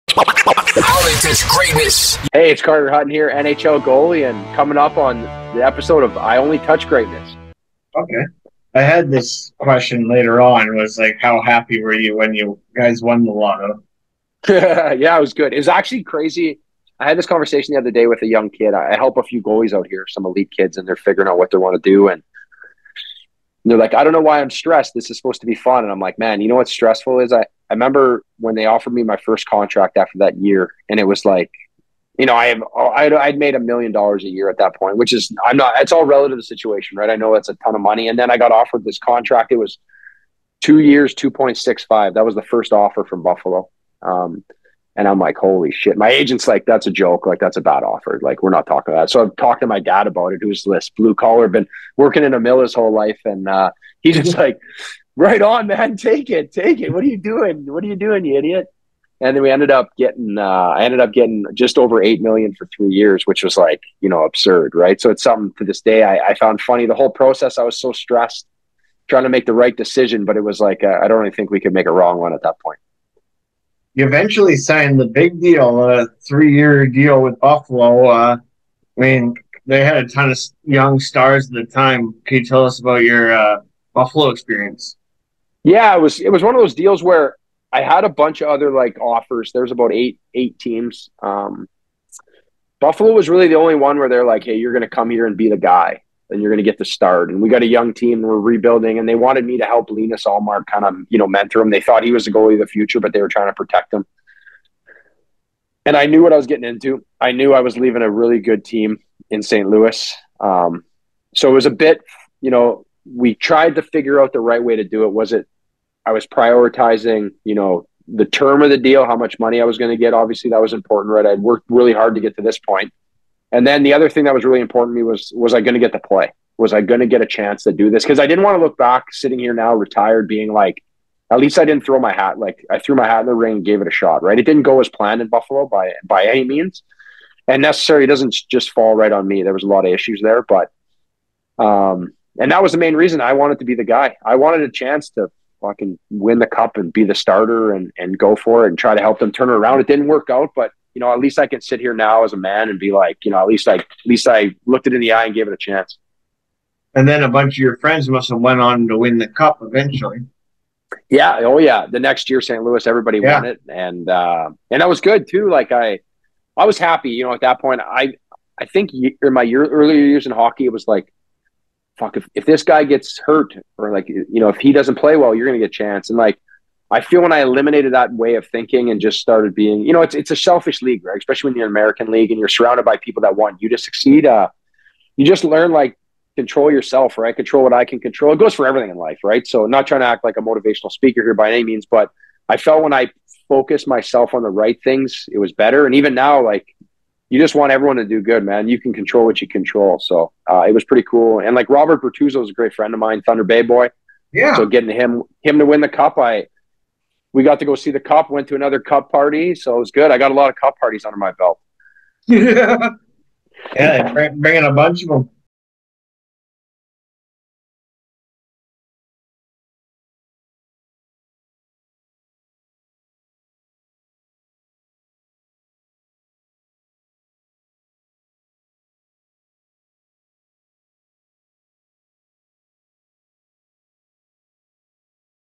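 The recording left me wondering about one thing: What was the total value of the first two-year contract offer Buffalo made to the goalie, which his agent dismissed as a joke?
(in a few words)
2.65 million.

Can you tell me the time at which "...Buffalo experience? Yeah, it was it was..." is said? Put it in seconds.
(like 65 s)
83 s.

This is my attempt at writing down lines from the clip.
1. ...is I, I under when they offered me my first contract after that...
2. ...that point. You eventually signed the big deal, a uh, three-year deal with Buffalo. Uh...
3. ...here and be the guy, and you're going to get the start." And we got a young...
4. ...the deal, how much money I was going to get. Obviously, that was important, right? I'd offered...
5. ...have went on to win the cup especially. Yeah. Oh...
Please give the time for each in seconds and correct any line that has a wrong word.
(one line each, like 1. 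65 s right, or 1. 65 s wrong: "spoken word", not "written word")
1. 27 s wrong: "remember", not "under"
2. 72 s right
3. 95 s right
4. 118 s wrong: "worked", not "offered"
5. 158 s wrong: "eventually", not "especially".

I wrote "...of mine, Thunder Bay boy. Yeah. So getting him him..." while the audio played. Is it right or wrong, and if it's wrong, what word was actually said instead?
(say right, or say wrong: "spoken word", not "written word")
right.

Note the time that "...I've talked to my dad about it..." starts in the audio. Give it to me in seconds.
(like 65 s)
49 s.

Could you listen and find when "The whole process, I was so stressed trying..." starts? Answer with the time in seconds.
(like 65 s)
66 s.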